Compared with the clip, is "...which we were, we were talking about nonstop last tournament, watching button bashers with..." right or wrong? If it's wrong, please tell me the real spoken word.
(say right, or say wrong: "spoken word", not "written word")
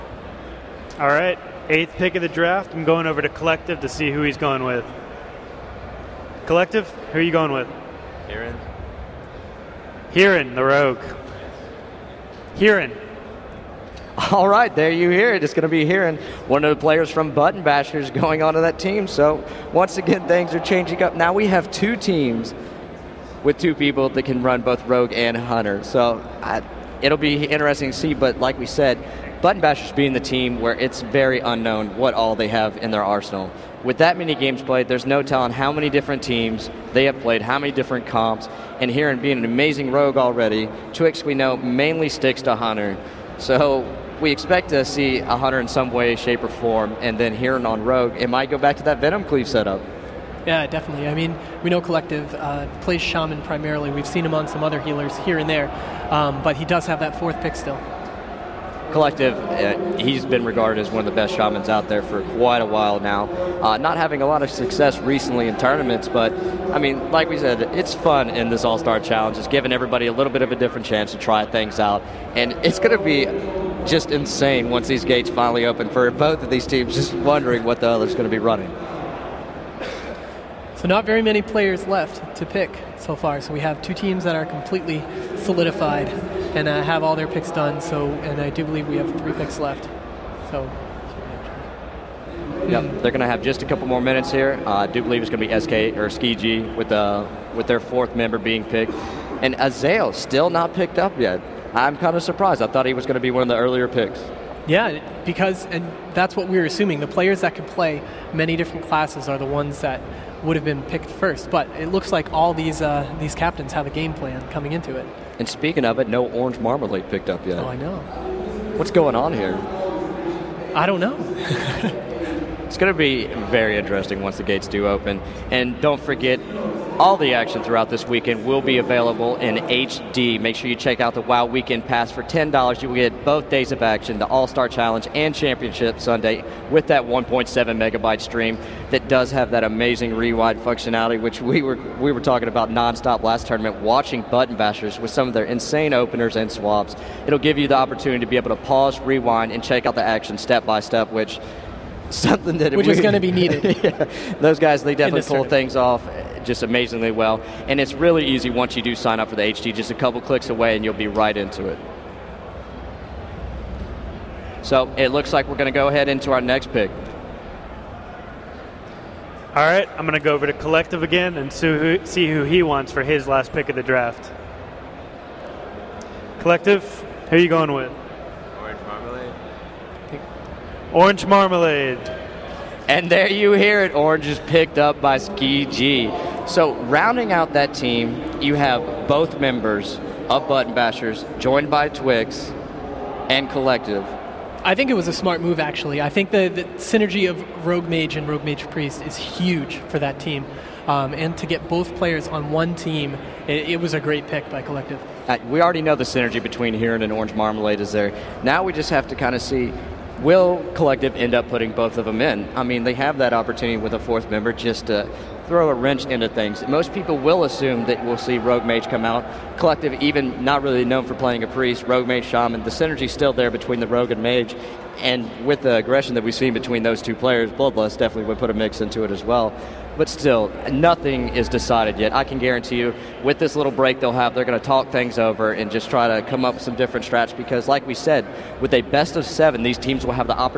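right.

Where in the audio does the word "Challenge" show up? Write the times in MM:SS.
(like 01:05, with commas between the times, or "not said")
01:09, 02:14.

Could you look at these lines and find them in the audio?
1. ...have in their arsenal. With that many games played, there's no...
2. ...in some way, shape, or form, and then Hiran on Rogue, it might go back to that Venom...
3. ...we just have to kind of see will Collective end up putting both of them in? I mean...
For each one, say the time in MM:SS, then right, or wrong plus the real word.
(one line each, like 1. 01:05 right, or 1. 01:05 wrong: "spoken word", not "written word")
1. 00:32 right
2. 00:45 right
3. 03:28 right.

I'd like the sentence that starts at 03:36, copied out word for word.
Most people will assume that we'll see Rogue Mage come out.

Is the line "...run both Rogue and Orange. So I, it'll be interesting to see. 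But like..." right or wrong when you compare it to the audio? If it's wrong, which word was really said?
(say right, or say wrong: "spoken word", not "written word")
wrong: "Hunter", not "Orange".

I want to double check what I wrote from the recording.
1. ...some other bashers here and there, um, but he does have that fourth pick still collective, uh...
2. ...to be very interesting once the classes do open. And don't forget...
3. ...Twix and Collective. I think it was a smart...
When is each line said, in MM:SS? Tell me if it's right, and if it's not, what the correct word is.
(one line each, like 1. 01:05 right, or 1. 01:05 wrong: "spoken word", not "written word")
1. 00:54 wrong: "healers", not "bashers"
2. 02:02 wrong: "gates", not "classes"
3. 03:11 right.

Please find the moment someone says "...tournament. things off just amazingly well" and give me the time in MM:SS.
02:35.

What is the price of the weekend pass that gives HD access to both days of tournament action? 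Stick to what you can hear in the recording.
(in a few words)
$10.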